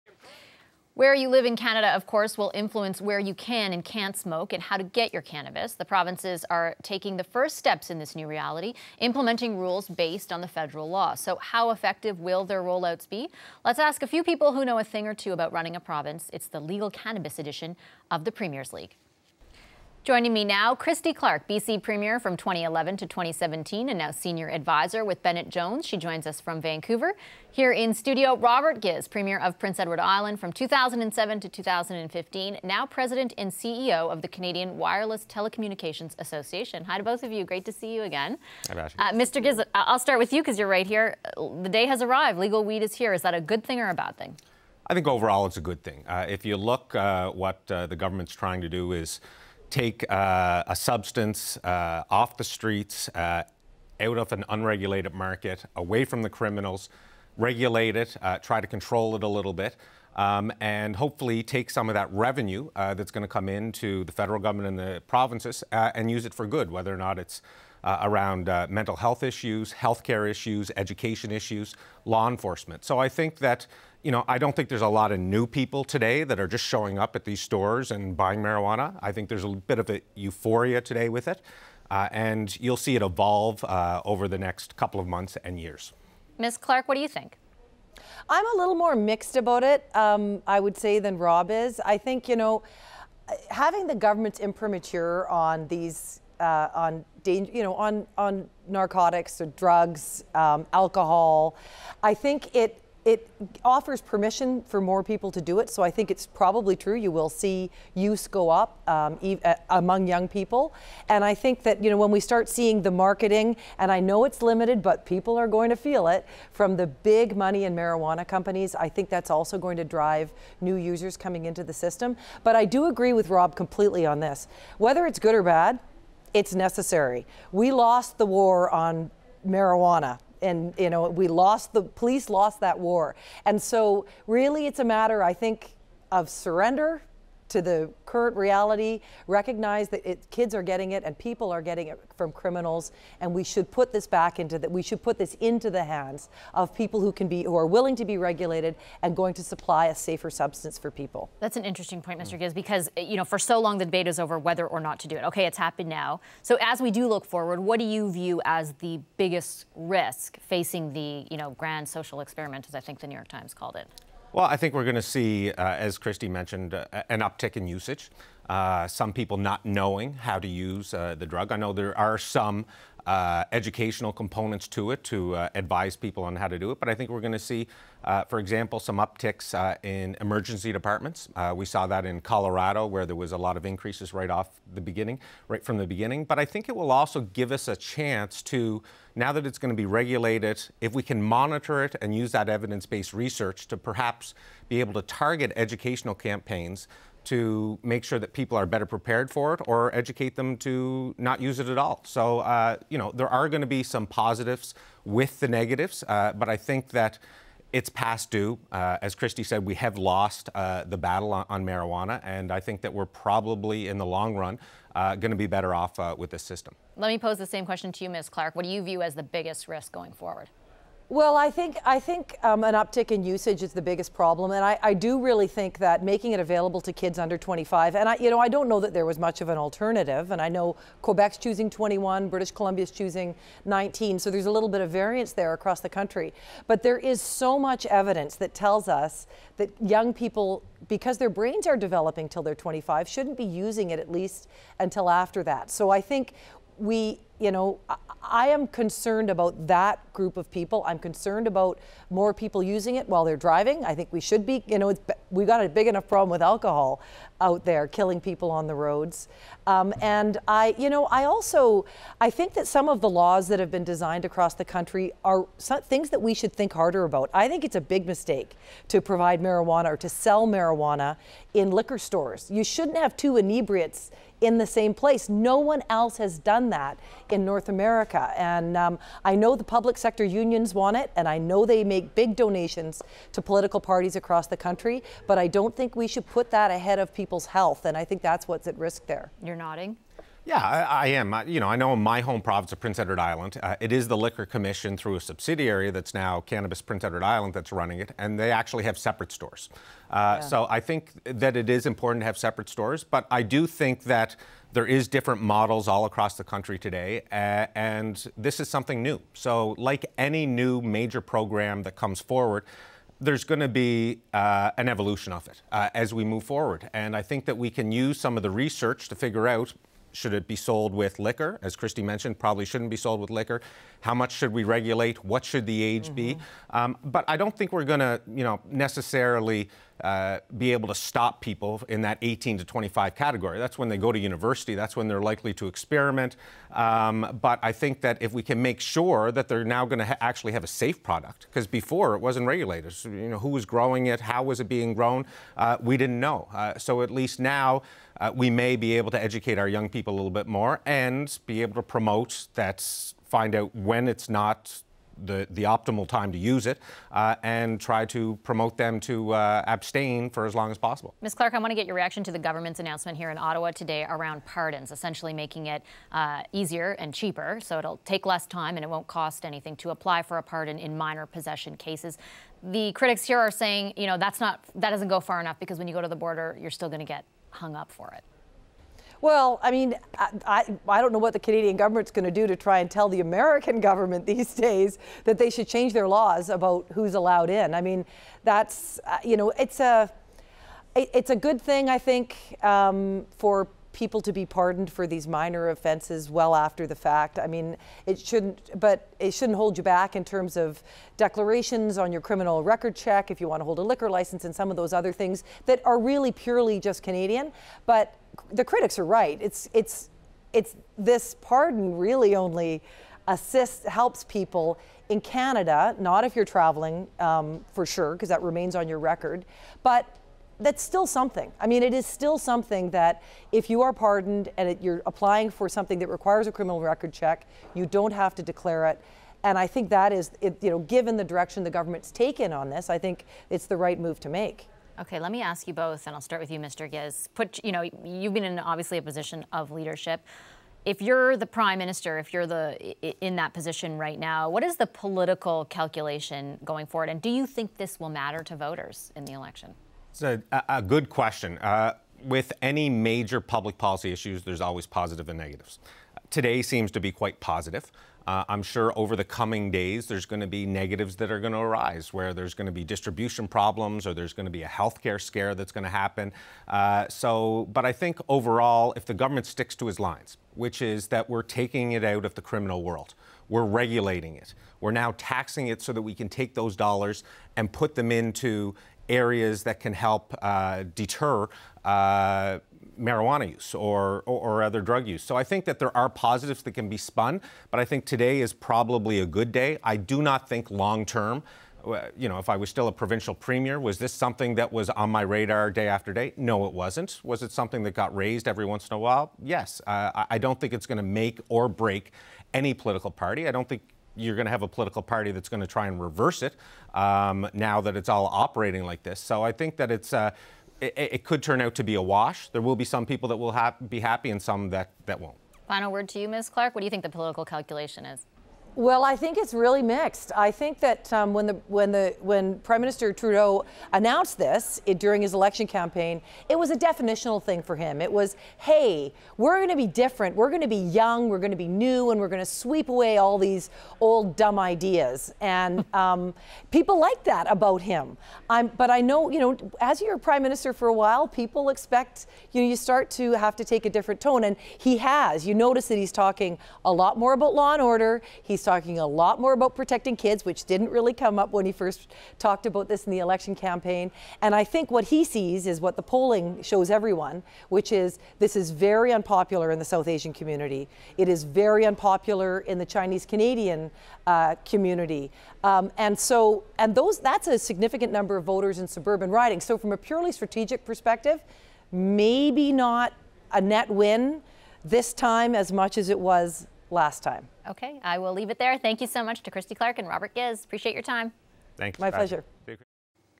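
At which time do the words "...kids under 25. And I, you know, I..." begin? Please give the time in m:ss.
3:46.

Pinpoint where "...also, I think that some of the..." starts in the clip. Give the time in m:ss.
4:21.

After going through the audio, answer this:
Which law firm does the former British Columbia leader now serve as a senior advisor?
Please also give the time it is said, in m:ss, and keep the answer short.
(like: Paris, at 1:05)
Bennett Jones, at 0:25.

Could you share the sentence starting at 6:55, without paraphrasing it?
Not if you're traveling um, for sure, because that remains on your record, but that's still something.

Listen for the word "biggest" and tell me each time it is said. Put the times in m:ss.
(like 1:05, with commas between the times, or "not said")
2:39, 3:39, 3:43.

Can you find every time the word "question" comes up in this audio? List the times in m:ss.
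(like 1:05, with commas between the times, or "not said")
3:37, 7:31.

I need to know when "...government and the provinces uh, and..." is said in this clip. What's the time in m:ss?
1:04.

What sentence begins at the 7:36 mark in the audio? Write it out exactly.
Today seems to be quite positive.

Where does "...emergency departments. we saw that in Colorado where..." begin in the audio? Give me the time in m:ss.
3:00.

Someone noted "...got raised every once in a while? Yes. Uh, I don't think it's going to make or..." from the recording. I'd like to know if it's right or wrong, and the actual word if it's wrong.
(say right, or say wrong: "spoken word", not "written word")
right.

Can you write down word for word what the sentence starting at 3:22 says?
So, uh, you know, there are going to be some positives with the negatives, uh, but I think that it's past due.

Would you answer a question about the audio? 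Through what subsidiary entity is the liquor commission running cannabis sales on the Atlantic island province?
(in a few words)
Cannabis Prince Edward Island.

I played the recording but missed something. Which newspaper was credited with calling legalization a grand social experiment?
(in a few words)
New York Times.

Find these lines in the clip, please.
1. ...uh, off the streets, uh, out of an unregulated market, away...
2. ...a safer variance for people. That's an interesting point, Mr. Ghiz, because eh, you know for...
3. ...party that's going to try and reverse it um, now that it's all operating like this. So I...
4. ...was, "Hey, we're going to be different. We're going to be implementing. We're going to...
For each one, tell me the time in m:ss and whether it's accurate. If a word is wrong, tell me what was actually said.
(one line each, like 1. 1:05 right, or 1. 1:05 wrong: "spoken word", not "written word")
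1. 0:51 right
2. 2:29 wrong: "substance", not "variance"
3. 8:25 right
4. 8:48 wrong: "young", not "implementing".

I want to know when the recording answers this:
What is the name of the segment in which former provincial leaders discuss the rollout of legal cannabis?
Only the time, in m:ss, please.
0:18.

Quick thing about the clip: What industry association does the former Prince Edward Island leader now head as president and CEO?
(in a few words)
Canadian Wireless Telecommunications Association.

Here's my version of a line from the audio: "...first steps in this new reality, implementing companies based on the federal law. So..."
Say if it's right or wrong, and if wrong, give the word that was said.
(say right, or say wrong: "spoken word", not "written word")
wrong: "rules", not "companies".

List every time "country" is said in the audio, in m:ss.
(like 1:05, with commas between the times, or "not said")
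3:55, 4:24, 4:44, 5:06.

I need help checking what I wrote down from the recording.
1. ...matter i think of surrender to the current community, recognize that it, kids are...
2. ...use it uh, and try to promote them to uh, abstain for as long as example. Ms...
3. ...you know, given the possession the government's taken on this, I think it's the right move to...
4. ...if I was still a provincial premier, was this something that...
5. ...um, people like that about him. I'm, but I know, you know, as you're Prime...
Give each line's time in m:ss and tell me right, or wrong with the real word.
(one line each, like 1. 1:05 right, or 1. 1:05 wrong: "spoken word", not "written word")
1. 2:14 wrong: "reality", not "community"
2. 5:56 wrong: "possible", not "example"
3. 7:10 wrong: "direction", not "possession"
4. 8:12 right
5. 8:55 right.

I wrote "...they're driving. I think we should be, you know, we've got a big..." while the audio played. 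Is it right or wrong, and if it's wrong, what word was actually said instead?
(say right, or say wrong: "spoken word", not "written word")
right.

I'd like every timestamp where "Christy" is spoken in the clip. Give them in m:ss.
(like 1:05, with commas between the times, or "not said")
0:20, 2:45, 3:29, 5:21, 9:39.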